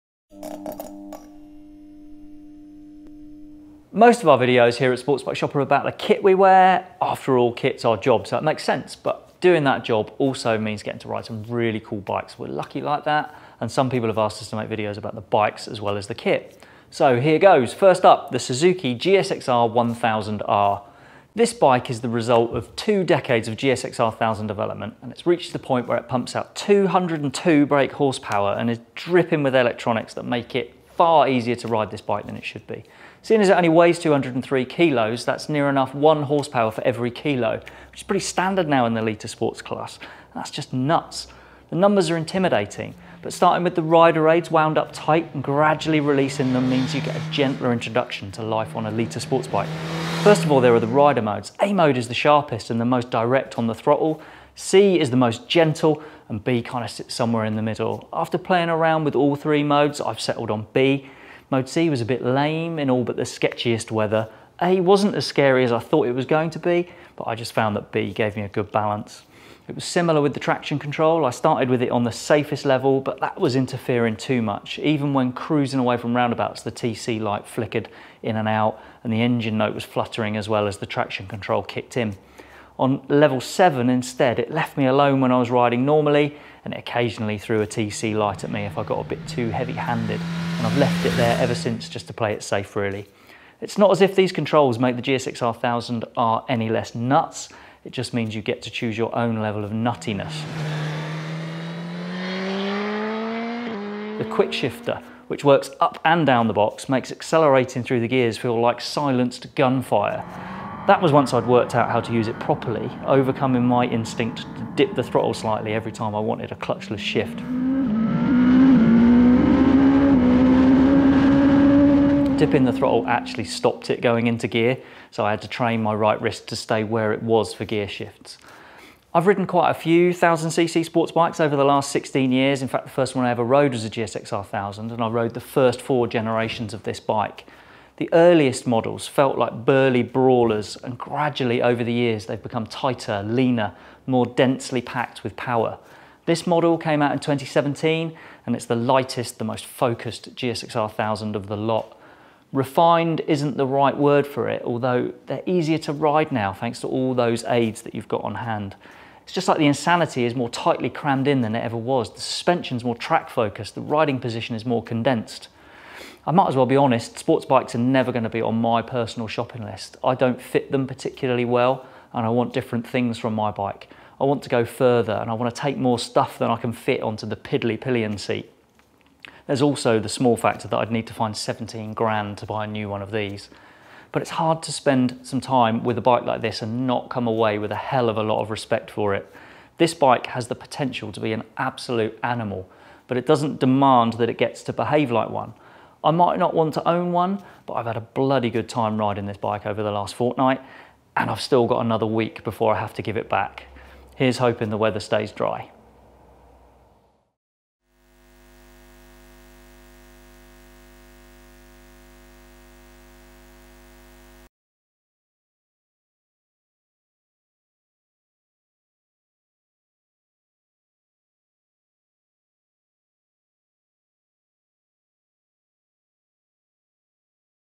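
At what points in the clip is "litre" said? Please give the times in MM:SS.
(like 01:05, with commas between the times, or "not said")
00:39, 00:48.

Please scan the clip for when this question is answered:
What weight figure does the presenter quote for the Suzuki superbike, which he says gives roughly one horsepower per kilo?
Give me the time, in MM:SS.
00:33.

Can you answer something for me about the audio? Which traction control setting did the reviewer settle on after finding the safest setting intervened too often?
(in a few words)
Level 7.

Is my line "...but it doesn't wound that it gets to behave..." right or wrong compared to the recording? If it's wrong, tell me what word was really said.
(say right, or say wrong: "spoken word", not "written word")
wrong: "demand", not "wound".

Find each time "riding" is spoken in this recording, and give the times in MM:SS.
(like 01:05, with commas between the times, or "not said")
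01:25, 02:43, 03:18.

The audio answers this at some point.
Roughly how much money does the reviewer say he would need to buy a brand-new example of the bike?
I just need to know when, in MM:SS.
03:01.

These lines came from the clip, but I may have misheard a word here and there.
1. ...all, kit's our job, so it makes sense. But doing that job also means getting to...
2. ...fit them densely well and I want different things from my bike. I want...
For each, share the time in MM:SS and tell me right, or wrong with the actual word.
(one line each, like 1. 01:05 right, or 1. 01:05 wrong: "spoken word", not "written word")
1. 00:07 right
2. 02:50 wrong: "particularly", not "densely".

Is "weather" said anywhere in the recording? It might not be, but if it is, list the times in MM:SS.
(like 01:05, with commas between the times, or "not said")
01:03, 03:24.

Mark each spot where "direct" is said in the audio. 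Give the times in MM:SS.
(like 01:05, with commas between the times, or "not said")
00:53.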